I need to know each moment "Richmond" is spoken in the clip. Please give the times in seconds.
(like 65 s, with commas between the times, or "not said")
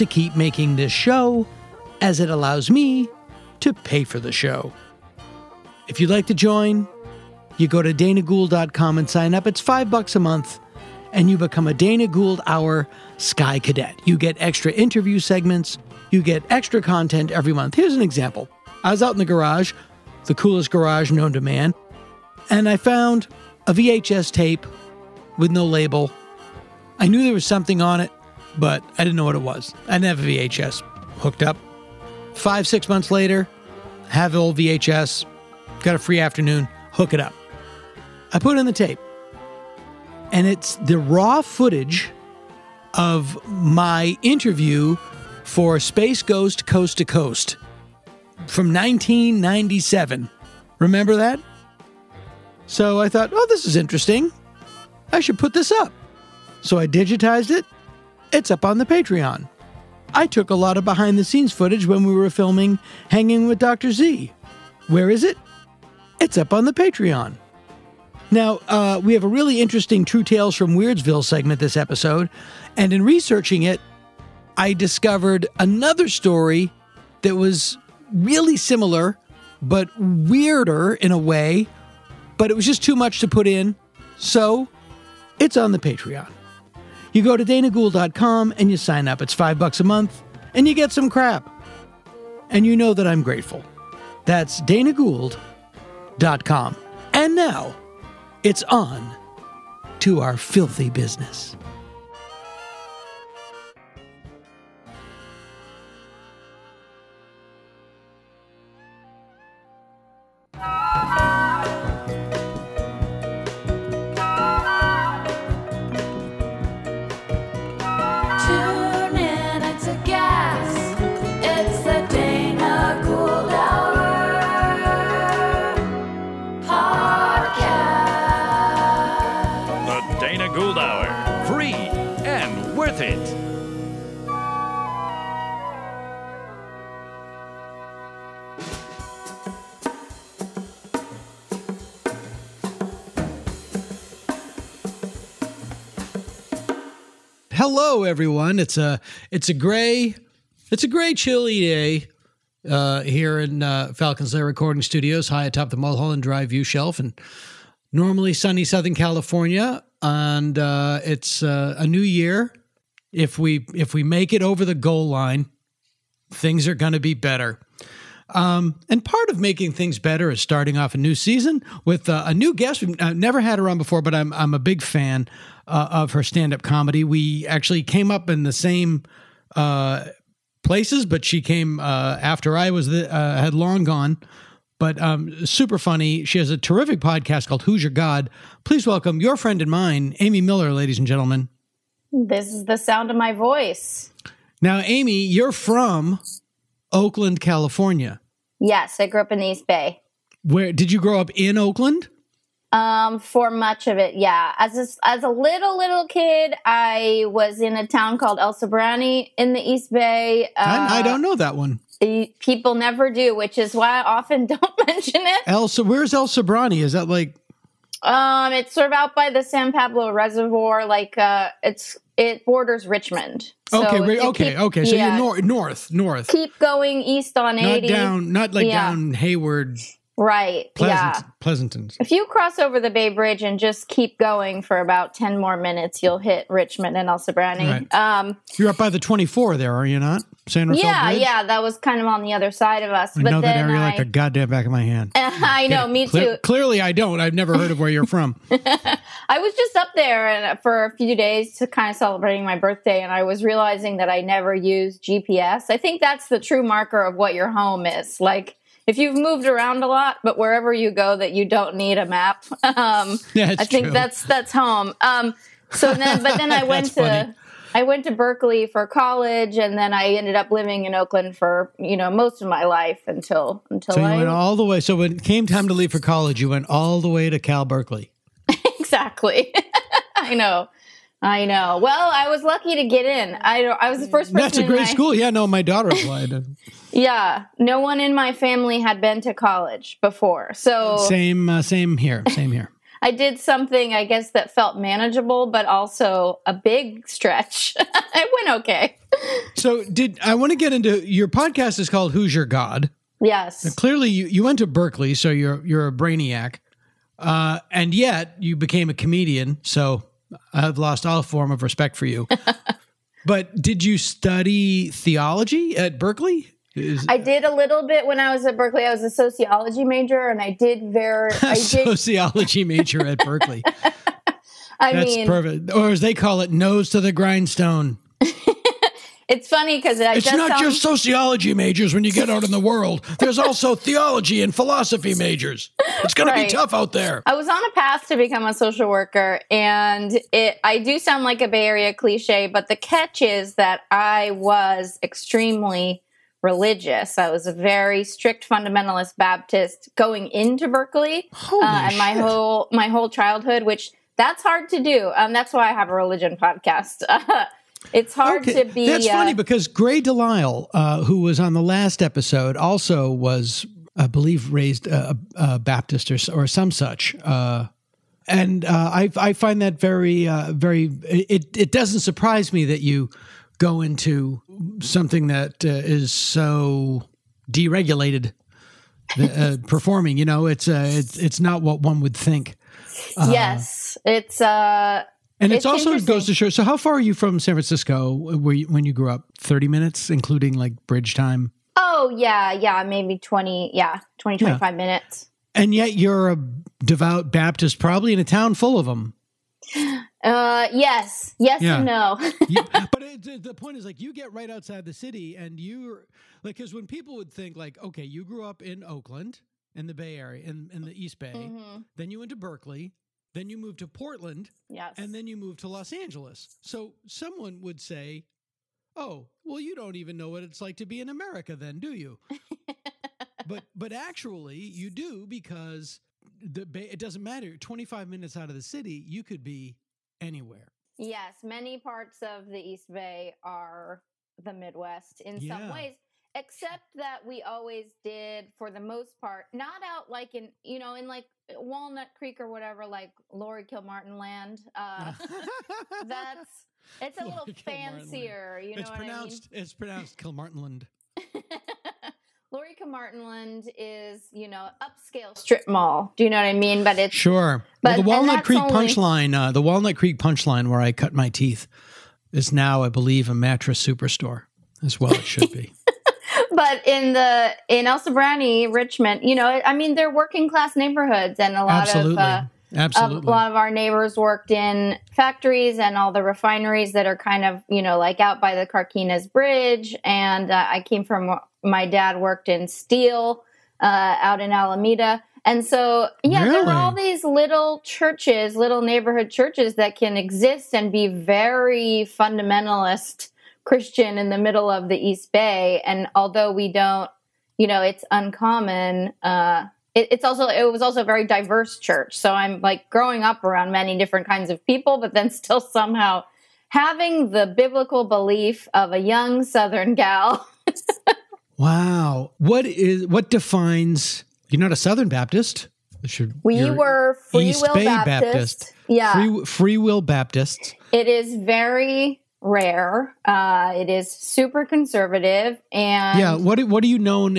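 222 s, 236 s, 468 s.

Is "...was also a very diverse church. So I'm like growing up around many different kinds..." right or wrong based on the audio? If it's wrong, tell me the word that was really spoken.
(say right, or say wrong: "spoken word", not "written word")
right.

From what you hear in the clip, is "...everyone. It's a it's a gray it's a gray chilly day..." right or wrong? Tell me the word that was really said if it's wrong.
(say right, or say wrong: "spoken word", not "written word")
right.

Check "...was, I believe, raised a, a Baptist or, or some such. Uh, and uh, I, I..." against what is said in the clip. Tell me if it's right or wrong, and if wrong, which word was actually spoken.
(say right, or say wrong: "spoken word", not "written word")
right.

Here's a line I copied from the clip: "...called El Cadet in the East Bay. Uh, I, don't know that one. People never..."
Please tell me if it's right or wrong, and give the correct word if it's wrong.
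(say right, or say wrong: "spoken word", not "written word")
wrong: "Sobrante", not "Cadet".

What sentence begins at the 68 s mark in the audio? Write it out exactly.
Now, uh, we have a really interesting True Tales from Weirdsville segment this episode.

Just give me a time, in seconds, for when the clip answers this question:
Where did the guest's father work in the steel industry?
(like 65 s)
484 s.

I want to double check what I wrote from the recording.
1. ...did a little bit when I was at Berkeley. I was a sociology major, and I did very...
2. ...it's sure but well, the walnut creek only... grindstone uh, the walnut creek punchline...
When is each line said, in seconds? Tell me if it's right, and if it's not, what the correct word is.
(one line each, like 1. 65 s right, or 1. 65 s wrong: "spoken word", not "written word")
1. 317 s right
2. 456 s wrong: "punchline", not "grindstone".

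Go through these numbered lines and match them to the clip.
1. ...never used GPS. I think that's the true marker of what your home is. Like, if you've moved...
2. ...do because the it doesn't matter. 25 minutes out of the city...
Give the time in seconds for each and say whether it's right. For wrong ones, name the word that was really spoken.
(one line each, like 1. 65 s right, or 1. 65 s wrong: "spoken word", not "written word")
1. 254 s right
2. 424 s right.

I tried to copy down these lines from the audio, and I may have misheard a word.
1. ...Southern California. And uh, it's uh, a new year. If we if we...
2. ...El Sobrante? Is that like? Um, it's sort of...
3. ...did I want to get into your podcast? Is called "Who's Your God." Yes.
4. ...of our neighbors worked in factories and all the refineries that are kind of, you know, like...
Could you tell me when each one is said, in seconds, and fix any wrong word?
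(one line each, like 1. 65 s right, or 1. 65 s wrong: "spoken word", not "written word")
1. 158 s right
2. 216 s right
3. 299 s right
4. 473 s right.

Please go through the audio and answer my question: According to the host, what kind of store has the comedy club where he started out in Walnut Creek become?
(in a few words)
Mattress superstore.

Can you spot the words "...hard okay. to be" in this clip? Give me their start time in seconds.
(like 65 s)
358 s.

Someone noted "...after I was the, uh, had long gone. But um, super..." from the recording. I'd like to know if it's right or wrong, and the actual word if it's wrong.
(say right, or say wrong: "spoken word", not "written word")
right.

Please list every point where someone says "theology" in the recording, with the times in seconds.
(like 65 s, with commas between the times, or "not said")
314 s, 333 s.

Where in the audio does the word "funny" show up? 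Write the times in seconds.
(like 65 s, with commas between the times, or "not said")
185 s, 266 s, 329 s, 359 s.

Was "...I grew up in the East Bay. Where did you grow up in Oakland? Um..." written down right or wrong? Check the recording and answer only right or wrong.
right.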